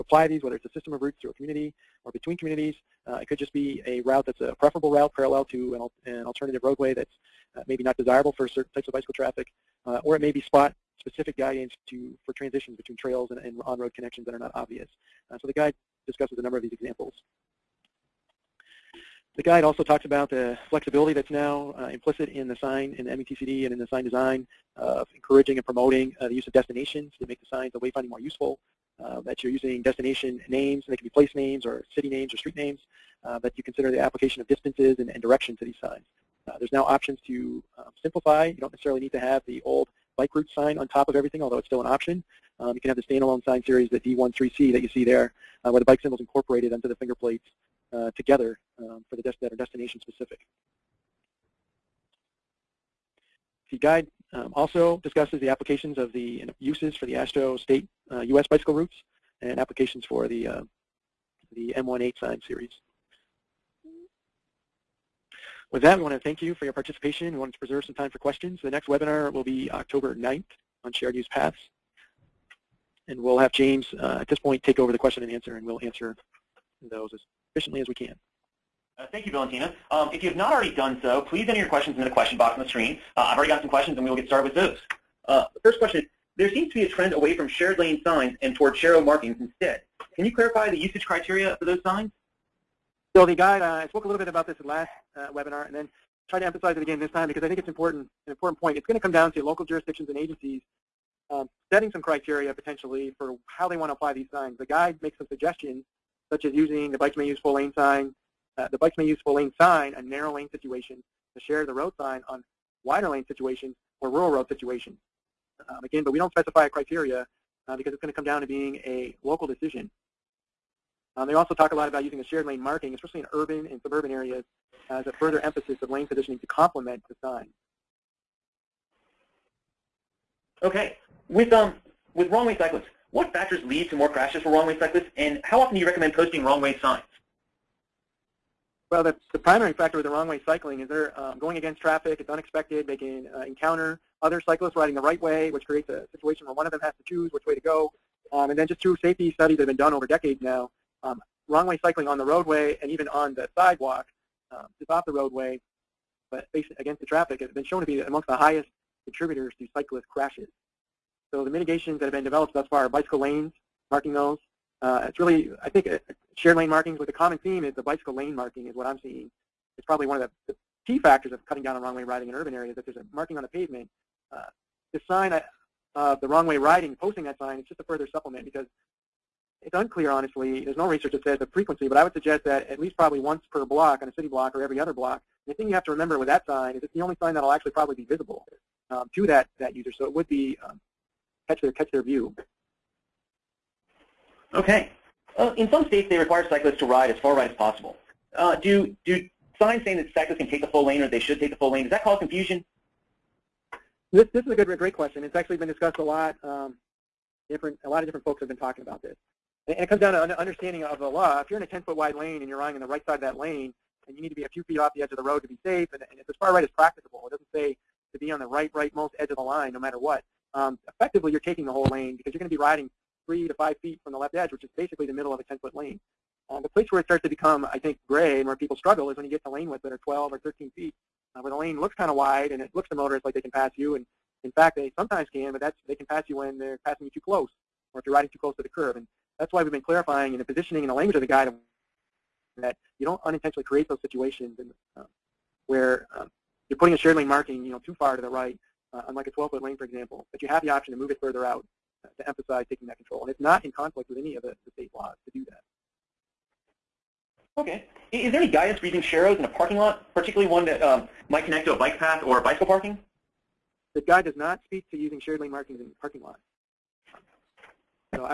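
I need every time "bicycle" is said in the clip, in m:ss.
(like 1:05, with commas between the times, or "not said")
0:08, 0:58, 2:42, 2:47, 4:22.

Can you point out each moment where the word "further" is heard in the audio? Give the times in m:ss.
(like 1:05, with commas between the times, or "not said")
2:05, 2:57, 4:11.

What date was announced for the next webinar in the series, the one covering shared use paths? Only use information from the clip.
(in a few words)
October 9th.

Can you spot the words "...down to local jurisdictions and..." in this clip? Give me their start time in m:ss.
1:39.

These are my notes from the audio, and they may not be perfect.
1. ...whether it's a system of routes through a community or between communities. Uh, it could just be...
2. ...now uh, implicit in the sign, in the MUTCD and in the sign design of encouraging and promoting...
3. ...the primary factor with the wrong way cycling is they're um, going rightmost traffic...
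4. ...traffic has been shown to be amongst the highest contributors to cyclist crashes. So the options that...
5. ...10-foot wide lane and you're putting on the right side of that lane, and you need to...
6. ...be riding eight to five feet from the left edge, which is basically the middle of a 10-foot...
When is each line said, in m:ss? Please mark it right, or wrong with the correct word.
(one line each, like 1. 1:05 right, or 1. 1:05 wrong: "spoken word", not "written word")
1. 0:00 right
2. 0:21 right
3. 2:19 wrong: "against", not "rightmost"
4. 2:37 wrong: "mitigations", not "options"
5. 3:31 wrong: "riding", not "putting"
6. 3:42 wrong: "three", not "eight".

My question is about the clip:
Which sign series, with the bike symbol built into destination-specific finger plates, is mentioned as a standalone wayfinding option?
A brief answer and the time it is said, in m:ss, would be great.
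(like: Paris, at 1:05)
D13C, at 0:43.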